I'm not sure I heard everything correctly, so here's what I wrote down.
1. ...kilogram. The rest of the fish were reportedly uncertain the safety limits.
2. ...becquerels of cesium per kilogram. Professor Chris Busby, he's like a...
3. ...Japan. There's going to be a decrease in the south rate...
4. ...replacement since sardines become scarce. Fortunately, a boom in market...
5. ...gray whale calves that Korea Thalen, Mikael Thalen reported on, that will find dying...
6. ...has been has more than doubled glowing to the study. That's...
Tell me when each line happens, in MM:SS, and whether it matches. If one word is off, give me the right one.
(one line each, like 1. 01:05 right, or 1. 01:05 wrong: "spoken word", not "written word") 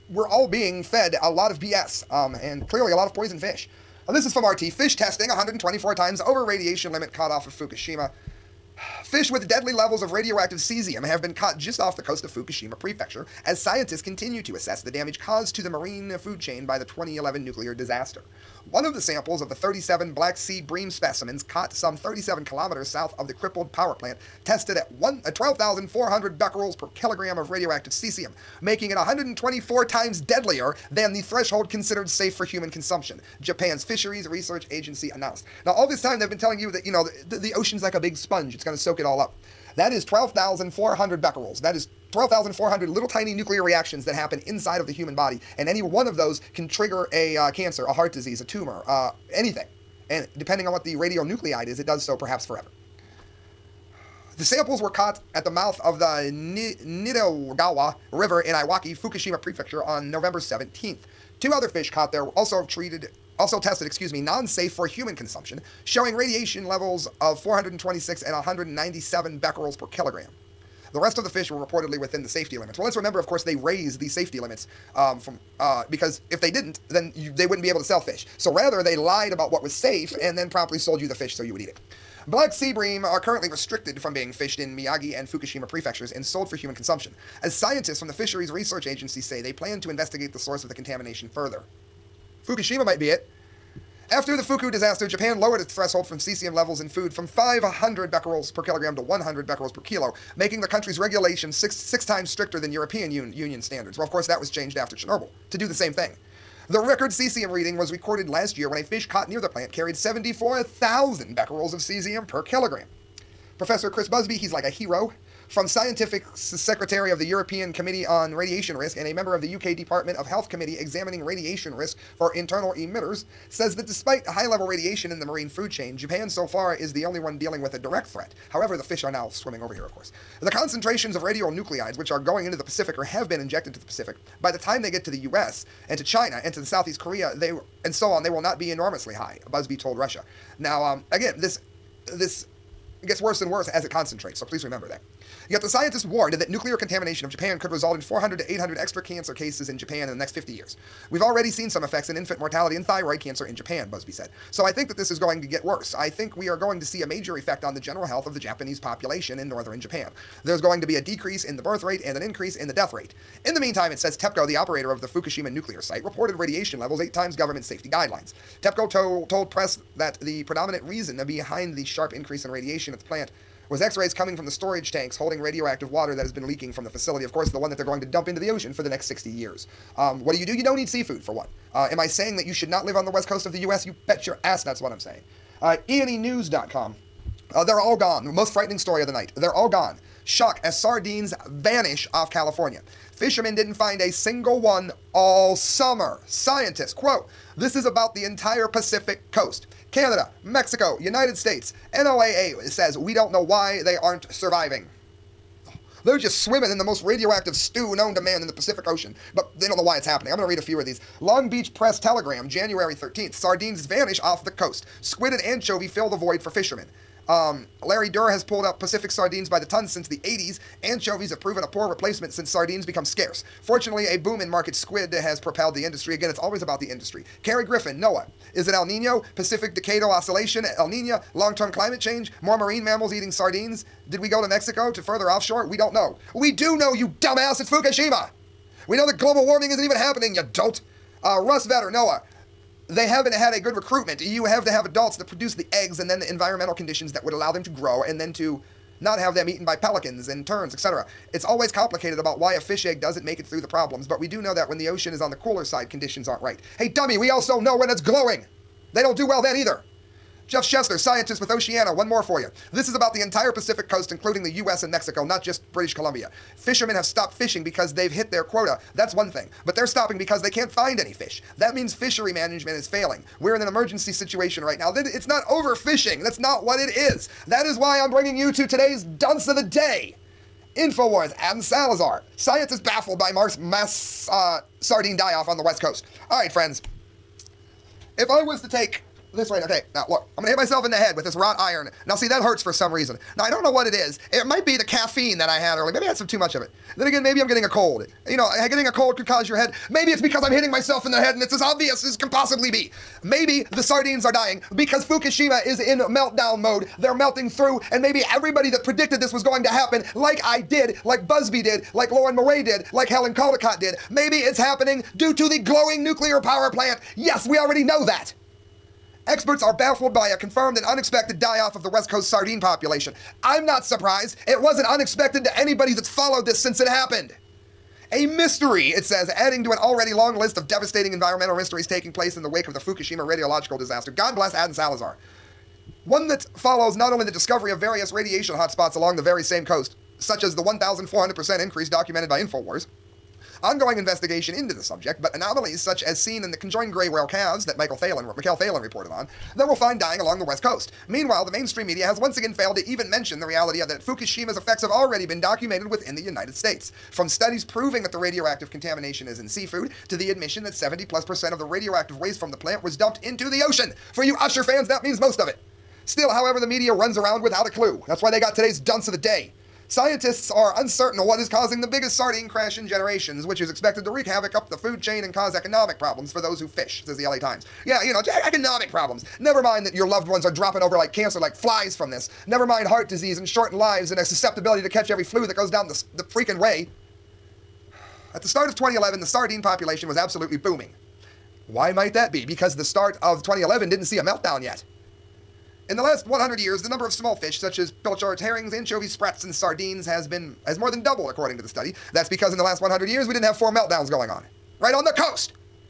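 1. 01:09 wrong: "within", not "uncertain"
2. 01:51 right
3. 02:39 wrong: "birth", not "south"
4. 03:41 right
5. 05:46 wrong: "Mikael", not "Korea"
6. 06:40 wrong: "according", not "glowing".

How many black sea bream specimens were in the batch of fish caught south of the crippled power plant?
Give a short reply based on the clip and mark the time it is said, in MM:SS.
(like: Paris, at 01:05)
37, at 00:19.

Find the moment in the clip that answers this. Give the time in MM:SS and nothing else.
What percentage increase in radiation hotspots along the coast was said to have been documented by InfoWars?
05:40.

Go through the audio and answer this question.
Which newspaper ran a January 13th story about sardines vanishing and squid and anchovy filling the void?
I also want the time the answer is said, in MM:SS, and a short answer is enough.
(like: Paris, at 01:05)
Long Beach Press Telegram, at 03:31.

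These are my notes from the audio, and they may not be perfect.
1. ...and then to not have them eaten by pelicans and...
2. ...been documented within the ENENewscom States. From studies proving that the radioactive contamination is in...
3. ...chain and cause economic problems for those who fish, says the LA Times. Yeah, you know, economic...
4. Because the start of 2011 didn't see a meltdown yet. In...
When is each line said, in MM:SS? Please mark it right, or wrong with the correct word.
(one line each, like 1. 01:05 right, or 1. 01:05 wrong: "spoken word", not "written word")
1. 04:08 right
2. 05:55 wrong: "United", not "ENENewscom"
3. 06:14 right
4. 06:32 right.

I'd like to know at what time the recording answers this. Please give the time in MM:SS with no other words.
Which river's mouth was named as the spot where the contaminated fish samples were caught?
00:56.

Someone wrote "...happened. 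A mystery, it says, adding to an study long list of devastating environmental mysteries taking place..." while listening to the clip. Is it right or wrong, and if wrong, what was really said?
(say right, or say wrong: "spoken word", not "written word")
wrong: "already", not "study".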